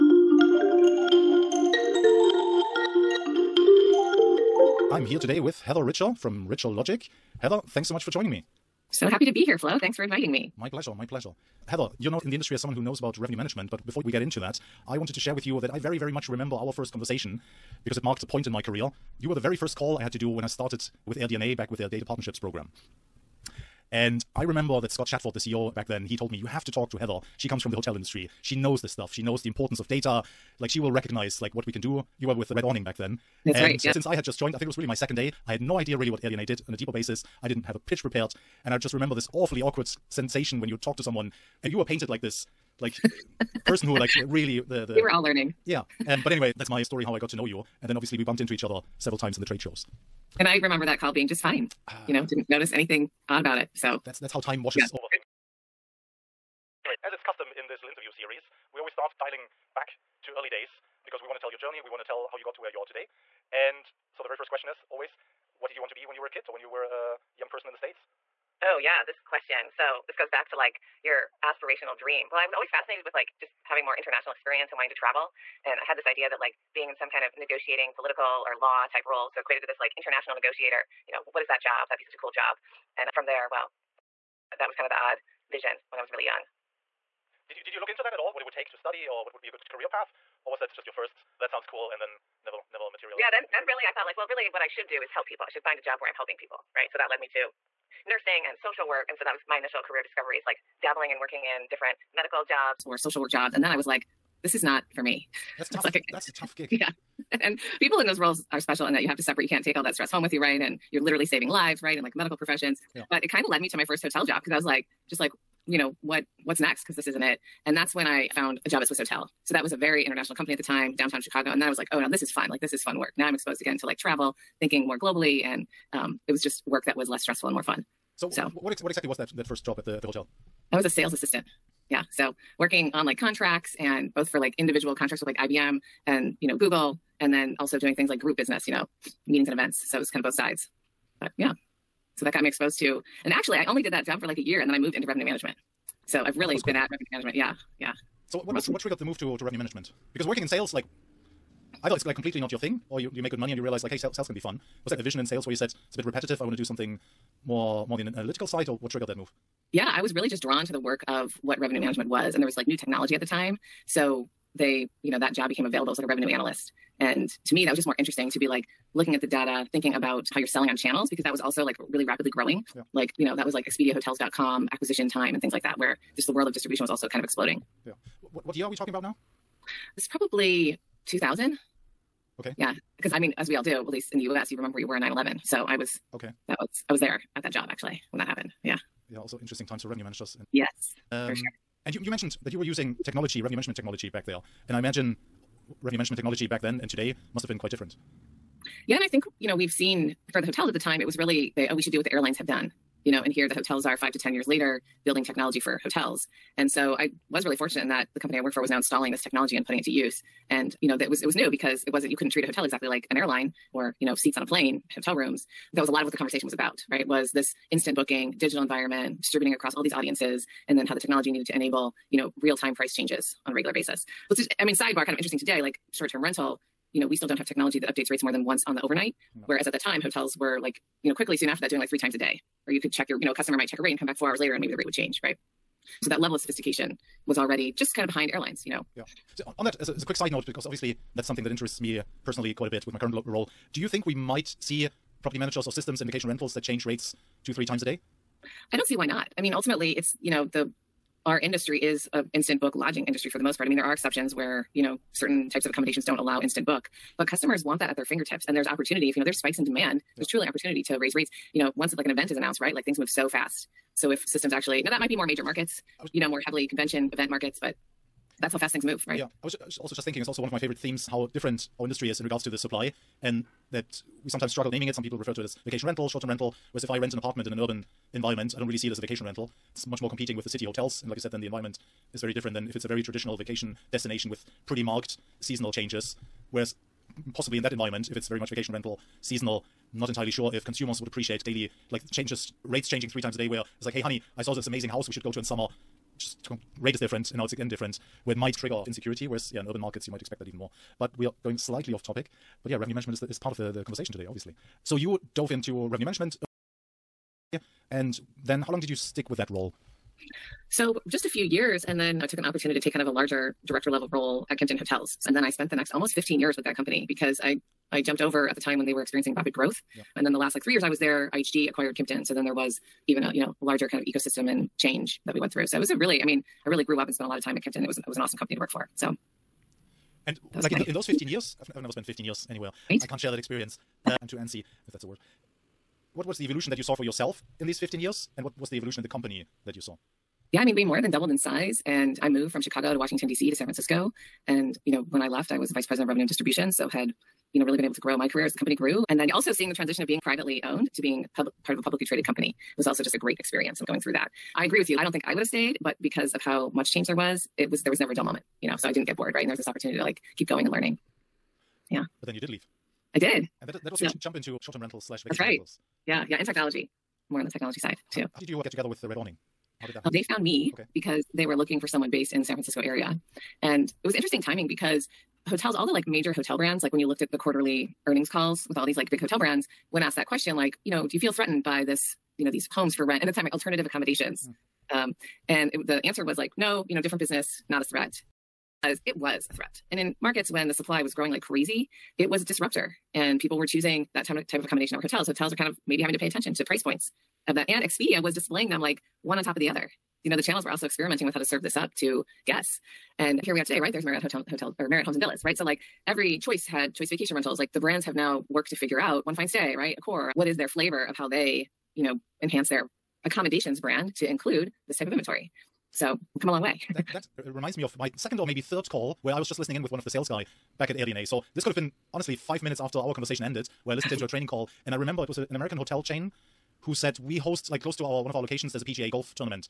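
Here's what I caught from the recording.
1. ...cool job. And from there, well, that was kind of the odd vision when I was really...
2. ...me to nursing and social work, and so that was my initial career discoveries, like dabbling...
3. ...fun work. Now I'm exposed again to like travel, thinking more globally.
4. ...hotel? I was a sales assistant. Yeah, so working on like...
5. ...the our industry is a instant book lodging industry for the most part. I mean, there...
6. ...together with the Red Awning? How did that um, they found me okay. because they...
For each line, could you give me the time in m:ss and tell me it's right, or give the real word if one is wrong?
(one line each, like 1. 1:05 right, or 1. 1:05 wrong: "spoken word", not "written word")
1. 1:22 right
2. 1:37 right
3. 2:02 right
4. 2:10 right
5. 4:10 right
6. 6:08 right.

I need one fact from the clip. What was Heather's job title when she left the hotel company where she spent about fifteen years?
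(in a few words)
Vice president of revenue and distribution.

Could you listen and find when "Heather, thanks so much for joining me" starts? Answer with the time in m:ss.
0:07.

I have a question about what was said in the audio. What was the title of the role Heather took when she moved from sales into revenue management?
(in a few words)
Revenue analyst.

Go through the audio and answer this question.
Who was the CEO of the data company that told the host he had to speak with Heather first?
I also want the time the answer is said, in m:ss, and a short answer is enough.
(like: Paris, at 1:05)
Scott Shatford, at 0:24.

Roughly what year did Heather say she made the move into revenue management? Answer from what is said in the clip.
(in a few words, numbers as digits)
2000.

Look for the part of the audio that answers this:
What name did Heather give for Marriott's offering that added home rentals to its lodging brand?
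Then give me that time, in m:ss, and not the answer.
6:44.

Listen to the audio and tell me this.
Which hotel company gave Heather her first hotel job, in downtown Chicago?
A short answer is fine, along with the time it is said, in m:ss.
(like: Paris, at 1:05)
Swissôtel, at 1:58.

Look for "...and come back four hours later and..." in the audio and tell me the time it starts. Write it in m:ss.
3:53.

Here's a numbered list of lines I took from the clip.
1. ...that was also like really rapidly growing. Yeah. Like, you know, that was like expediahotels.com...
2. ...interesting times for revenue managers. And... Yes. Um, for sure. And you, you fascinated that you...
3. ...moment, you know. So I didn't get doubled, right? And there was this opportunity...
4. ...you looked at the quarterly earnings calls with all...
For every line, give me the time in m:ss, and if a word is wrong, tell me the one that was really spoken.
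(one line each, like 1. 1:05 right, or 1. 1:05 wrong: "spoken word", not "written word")
1. 2:51 right
2. 3:09 wrong: "mentioned", not "fascinated"
3. 5:58 wrong: "bored", not "doubled"
4. 6:16 right.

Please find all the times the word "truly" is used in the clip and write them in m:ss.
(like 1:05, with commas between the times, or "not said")
4:20.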